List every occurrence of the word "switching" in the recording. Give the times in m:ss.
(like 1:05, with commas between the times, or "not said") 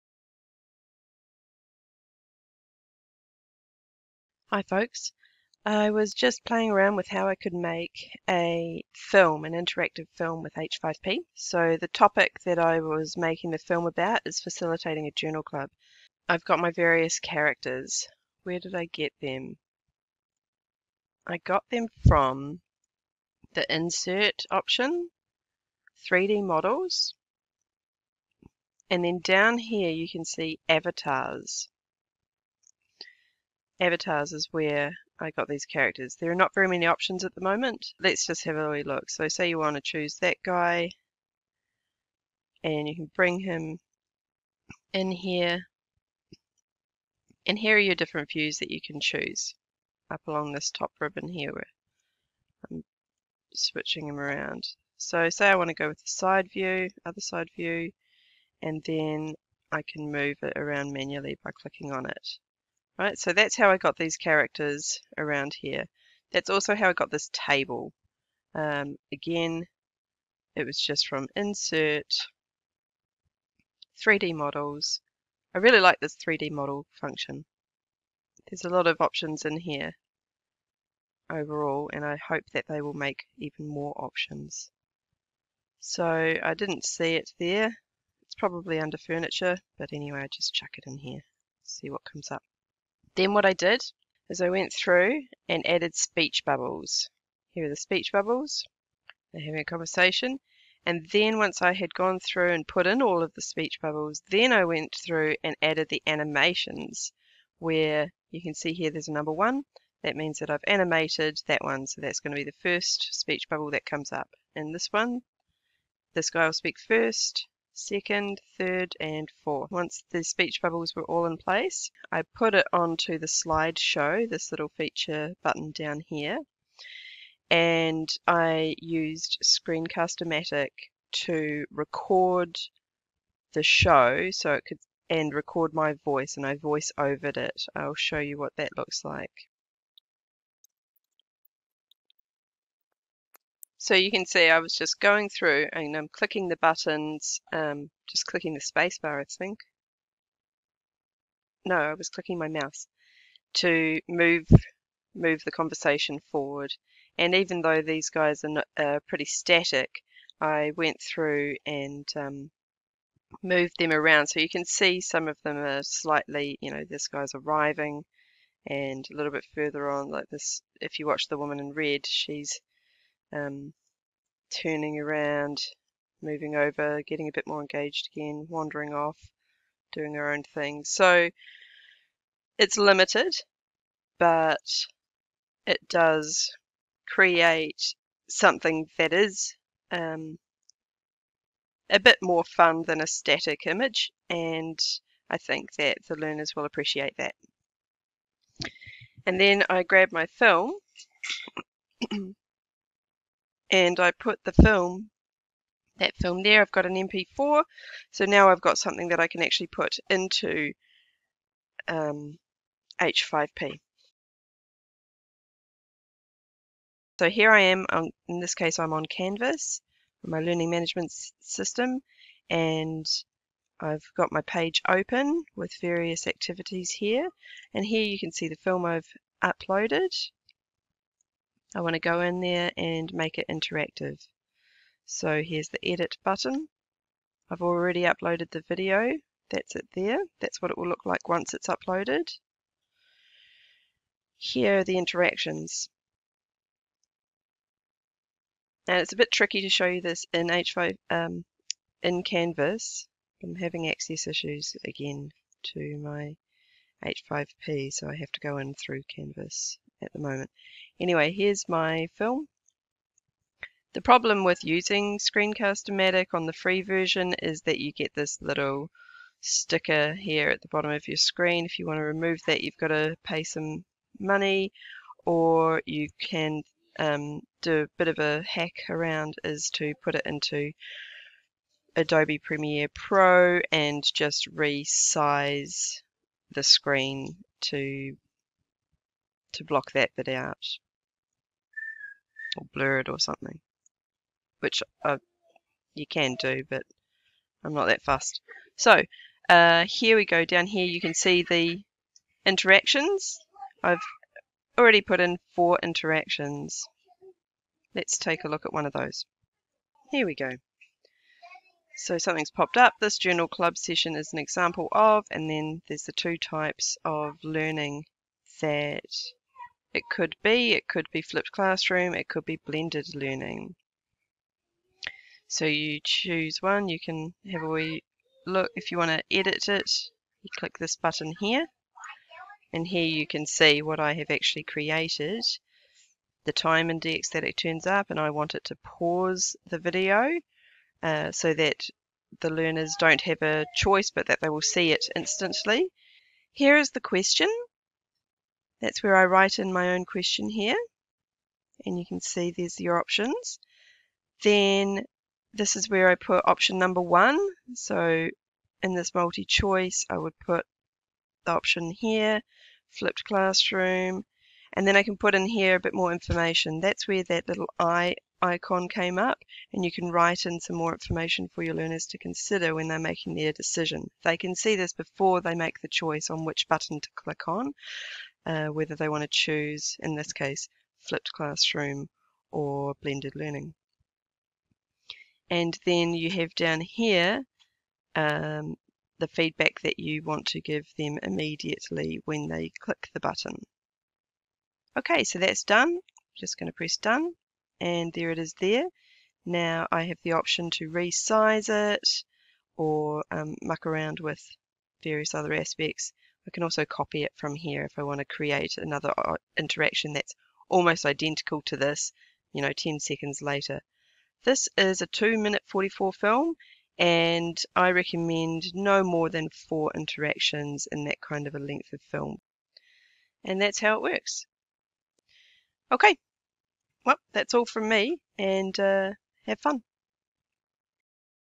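0:53.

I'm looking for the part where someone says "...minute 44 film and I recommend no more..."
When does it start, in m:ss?
6:55.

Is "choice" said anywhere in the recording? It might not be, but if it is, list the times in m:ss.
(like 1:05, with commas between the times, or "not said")
5:43, 5:59, 6:15.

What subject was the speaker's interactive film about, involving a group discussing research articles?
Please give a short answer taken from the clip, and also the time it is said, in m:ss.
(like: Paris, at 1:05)
Facilitating a journal club, at 0:14.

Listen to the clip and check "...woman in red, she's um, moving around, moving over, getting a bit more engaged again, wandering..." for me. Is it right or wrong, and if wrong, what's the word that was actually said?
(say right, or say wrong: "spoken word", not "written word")
wrong: "turning", not "moving".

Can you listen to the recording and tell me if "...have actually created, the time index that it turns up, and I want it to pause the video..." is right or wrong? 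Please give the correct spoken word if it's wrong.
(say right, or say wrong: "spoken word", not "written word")
right.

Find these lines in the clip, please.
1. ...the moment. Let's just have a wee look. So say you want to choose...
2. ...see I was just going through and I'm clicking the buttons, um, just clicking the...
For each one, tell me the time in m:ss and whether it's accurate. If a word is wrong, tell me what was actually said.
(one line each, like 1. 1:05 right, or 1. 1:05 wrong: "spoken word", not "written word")
1. 0:37 right
2. 2:24 right.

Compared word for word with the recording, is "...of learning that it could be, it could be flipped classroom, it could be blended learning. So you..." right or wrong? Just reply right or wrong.
right.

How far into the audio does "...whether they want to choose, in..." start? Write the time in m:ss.
6:18.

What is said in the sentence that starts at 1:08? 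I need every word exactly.
Um, again, it was just from insert, 3D models.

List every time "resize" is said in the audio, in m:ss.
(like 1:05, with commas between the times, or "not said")
4:44, 6:40.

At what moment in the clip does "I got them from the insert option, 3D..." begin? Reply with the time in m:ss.
0:21.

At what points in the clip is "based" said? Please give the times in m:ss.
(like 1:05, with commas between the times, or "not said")
not said.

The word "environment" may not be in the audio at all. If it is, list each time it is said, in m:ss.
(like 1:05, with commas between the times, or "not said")
not said.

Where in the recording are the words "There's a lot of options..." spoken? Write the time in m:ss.
1:18.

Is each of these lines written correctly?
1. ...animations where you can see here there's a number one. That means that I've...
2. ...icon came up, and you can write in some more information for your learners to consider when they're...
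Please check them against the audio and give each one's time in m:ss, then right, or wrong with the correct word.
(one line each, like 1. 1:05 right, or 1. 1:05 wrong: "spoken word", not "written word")
1. 1:46 right
2. 6:08 right.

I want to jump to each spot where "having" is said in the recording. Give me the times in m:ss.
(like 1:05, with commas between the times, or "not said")
1:39, 4:13.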